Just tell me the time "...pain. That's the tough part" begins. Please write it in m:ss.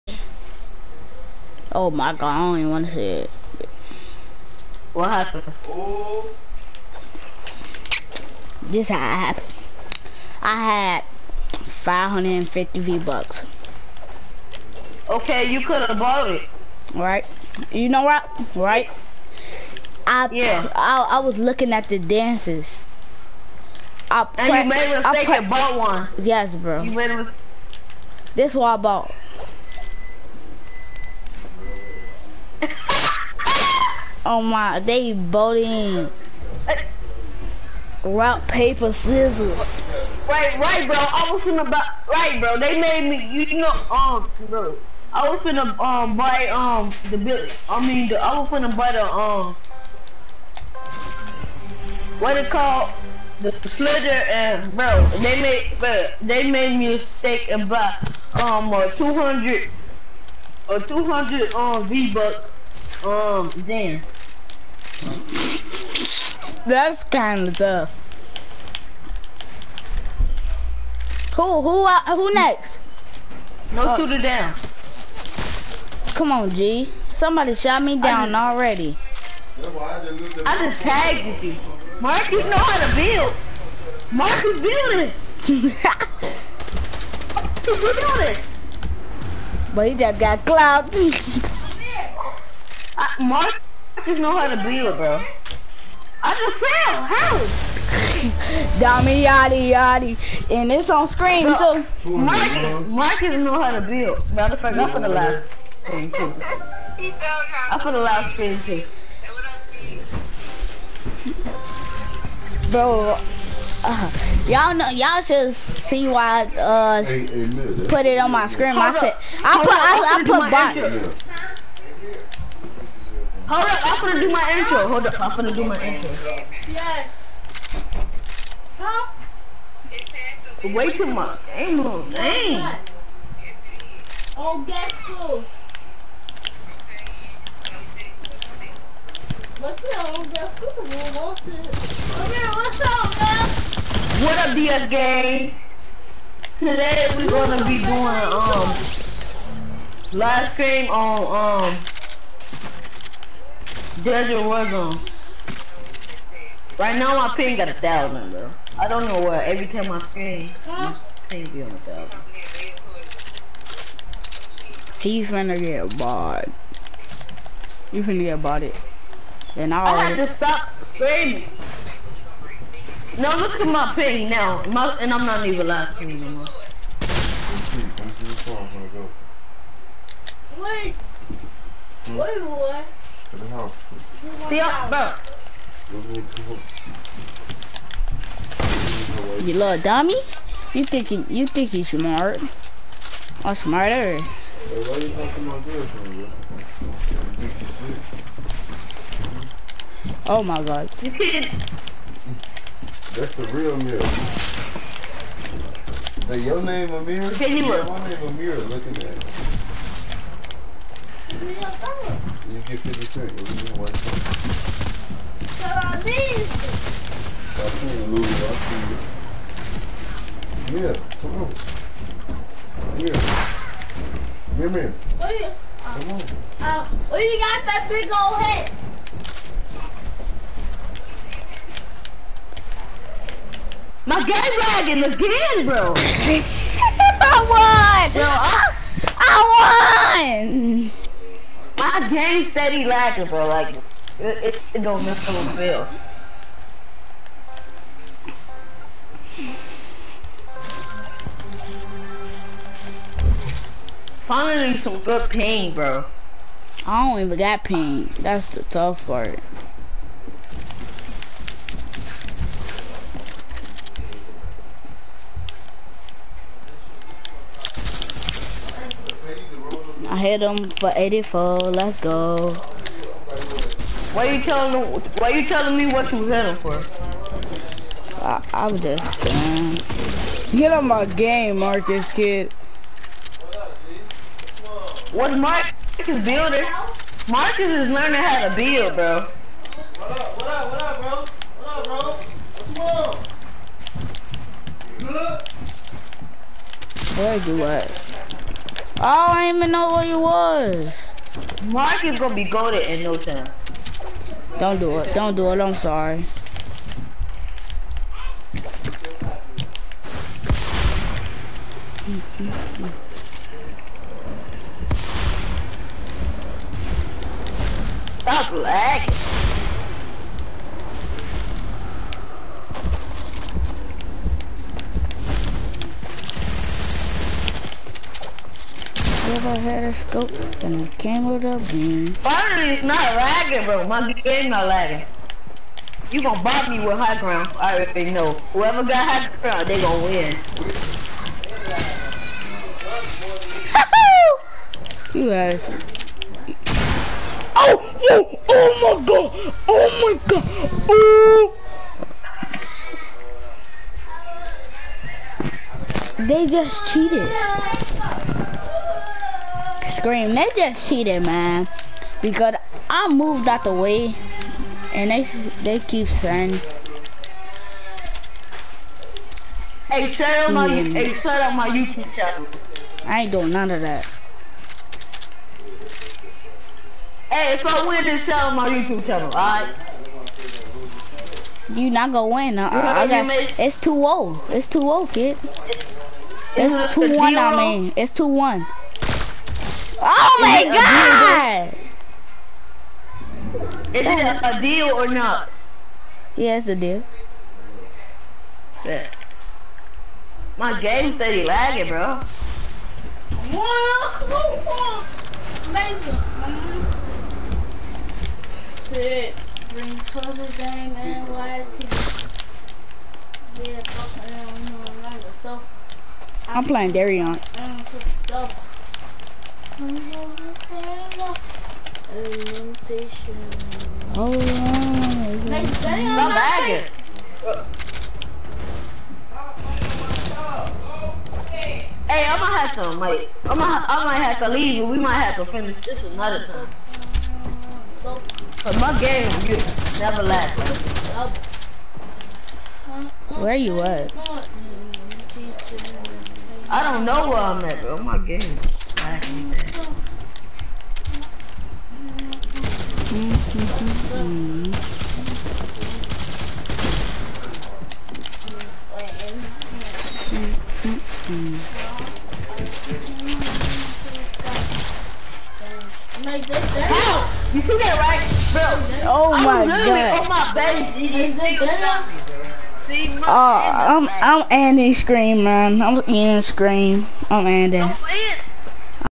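4:17.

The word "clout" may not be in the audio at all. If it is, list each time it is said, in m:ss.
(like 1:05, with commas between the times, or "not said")
1:30.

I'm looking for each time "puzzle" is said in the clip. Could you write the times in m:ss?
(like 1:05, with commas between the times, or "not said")
6:49.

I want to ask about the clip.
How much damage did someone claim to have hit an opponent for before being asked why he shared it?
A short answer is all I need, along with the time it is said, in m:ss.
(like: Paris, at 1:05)
84, at 4:30.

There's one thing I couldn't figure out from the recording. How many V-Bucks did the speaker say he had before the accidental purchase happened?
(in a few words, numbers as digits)
550.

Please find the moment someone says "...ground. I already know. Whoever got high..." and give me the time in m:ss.
5:37.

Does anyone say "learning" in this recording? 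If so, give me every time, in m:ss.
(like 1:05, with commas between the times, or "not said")
4:47.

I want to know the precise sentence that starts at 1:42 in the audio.
Marcus, Marcus know how to build.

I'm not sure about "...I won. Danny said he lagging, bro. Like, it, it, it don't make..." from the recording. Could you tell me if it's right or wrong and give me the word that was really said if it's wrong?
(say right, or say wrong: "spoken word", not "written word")
right.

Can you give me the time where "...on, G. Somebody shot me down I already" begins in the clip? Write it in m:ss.
1:16.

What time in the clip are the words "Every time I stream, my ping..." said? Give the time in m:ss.
2:39.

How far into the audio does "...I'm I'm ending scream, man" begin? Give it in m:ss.
7:53.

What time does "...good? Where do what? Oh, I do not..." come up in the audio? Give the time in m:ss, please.
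4:56.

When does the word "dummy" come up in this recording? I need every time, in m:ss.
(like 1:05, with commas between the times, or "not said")
1:38, 3:09.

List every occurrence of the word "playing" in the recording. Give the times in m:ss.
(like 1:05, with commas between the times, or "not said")
6:56.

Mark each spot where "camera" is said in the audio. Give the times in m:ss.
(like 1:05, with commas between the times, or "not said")
5:30.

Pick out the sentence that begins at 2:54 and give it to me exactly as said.
My, and I'm not even live streaming anymore.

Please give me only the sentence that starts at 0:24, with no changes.
I and you made a mistake and bought one.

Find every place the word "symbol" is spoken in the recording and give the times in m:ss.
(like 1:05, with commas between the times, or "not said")
not said.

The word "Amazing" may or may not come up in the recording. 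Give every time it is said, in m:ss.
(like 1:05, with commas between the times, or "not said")
6:45.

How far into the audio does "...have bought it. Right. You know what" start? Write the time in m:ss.
0:15.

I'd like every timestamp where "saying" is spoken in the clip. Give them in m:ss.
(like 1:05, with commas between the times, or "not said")
4:39, 6:06.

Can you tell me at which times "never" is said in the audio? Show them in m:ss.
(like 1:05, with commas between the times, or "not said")
7:19.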